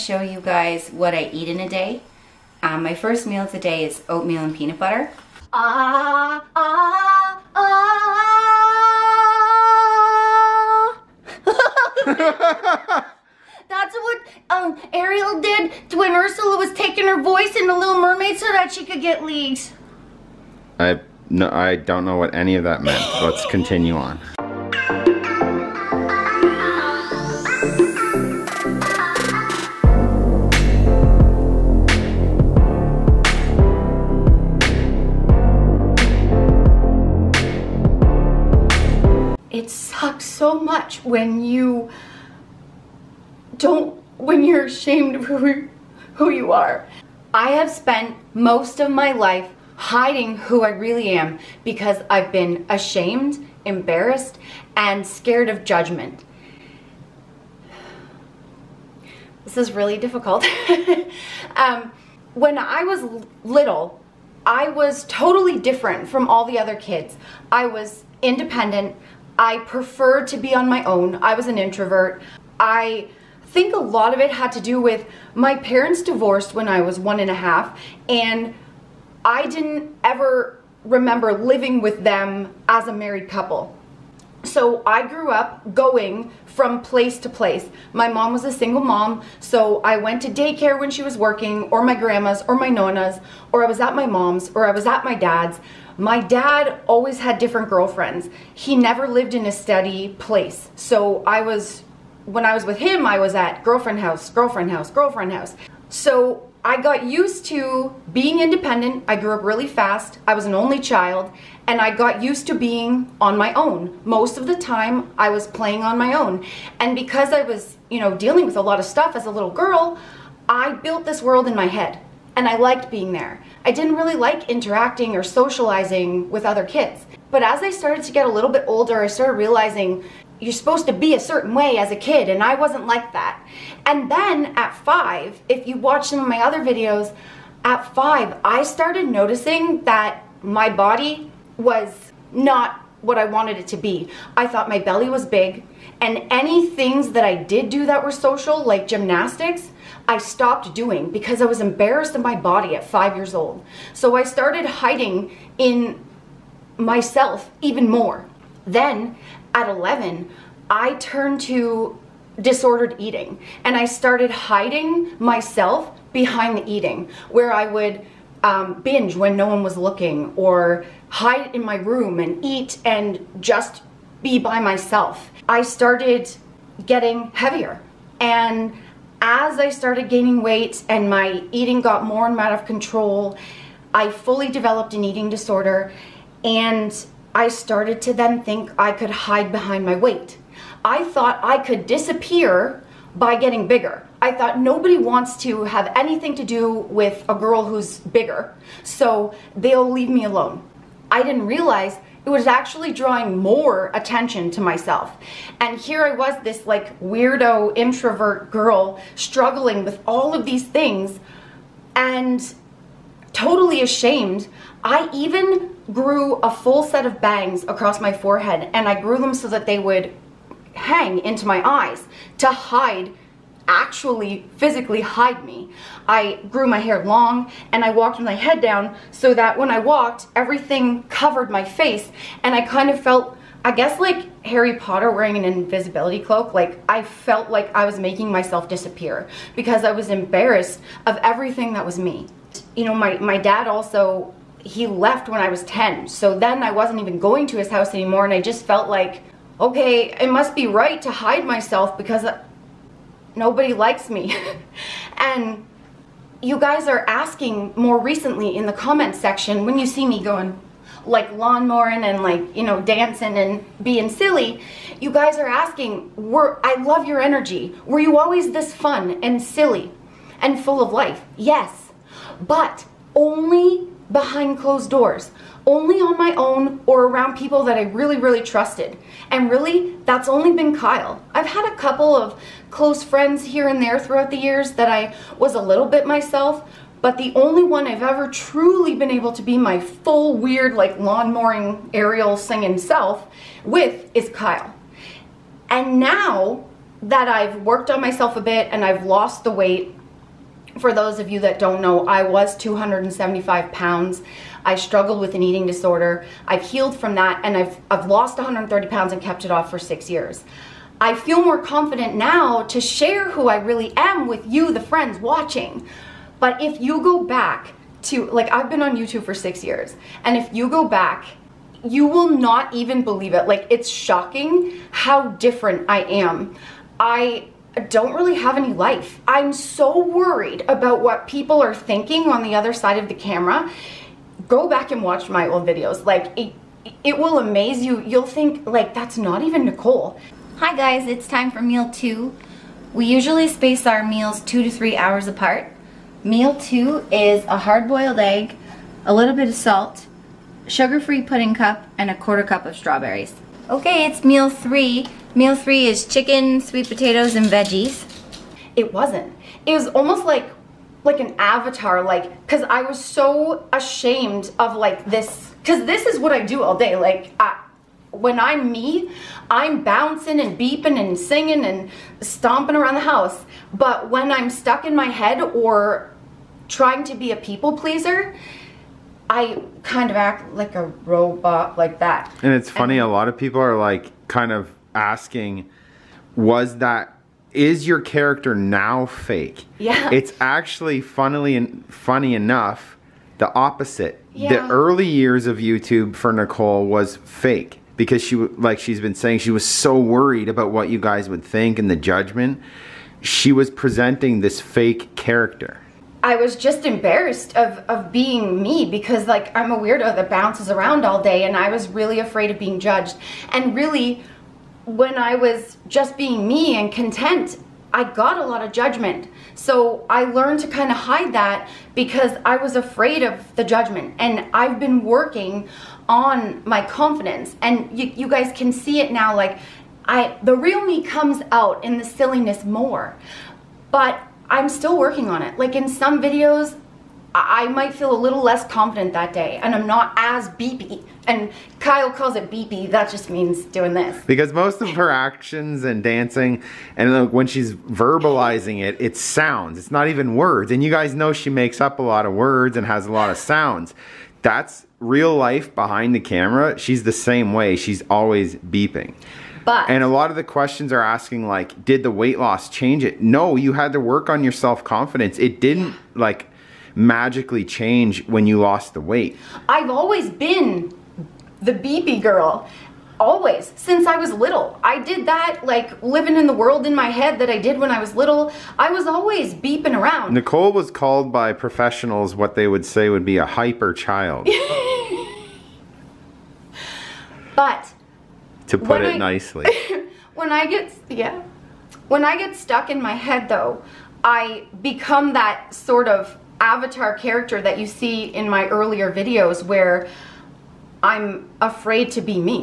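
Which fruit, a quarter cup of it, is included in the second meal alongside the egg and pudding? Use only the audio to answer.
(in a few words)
strawberries.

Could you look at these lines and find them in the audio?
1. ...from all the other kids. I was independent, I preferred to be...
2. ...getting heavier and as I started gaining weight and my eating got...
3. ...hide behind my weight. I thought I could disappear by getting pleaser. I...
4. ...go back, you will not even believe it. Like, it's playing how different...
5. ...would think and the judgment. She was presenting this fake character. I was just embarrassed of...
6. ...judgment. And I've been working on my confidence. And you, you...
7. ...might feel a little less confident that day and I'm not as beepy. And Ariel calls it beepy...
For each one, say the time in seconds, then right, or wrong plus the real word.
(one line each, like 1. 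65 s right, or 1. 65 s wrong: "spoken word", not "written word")
1. 66 s right
2. 176 s right
3. 189 s wrong: "bigger", not "pleaser"
4. 320 s wrong: "shocking", not "playing"
5. 401 s right
6. 423 s right
7. 437 s wrong: "Kyle", not "Ariel".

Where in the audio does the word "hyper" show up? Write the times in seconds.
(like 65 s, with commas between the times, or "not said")
483 s.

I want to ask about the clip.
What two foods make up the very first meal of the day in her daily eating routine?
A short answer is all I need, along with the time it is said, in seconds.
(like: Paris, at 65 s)
oatmeal and peanut butter, at 4 s.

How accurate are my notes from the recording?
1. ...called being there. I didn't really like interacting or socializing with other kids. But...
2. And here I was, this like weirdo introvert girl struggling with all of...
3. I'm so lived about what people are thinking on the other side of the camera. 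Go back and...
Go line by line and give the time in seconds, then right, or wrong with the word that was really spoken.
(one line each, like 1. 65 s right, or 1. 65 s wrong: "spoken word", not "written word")
1. 122 s wrong: "liked", not "called"
2. 205 s right
3. 329 s wrong: "worried", not "lived".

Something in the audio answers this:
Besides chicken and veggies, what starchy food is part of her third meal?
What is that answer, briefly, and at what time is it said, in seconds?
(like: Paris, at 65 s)
sweet potatoes, at 356 s.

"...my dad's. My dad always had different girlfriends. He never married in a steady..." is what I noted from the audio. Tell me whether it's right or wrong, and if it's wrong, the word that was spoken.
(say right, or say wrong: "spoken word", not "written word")
wrong: "lived", not "married".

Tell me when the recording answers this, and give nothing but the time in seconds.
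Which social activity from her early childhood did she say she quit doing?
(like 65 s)
148 s.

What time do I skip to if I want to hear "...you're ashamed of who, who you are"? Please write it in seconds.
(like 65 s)
44 s.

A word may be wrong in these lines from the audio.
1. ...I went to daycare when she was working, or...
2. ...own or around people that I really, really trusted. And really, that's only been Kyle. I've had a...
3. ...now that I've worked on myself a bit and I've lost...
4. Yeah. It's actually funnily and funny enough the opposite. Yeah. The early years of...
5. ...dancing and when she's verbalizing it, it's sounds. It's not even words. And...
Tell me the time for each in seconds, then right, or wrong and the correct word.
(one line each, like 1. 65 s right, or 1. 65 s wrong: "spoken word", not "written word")
1. 89 s right
2. 276 s right
3. 295 s right
4. 389 s right
5. 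446 s right.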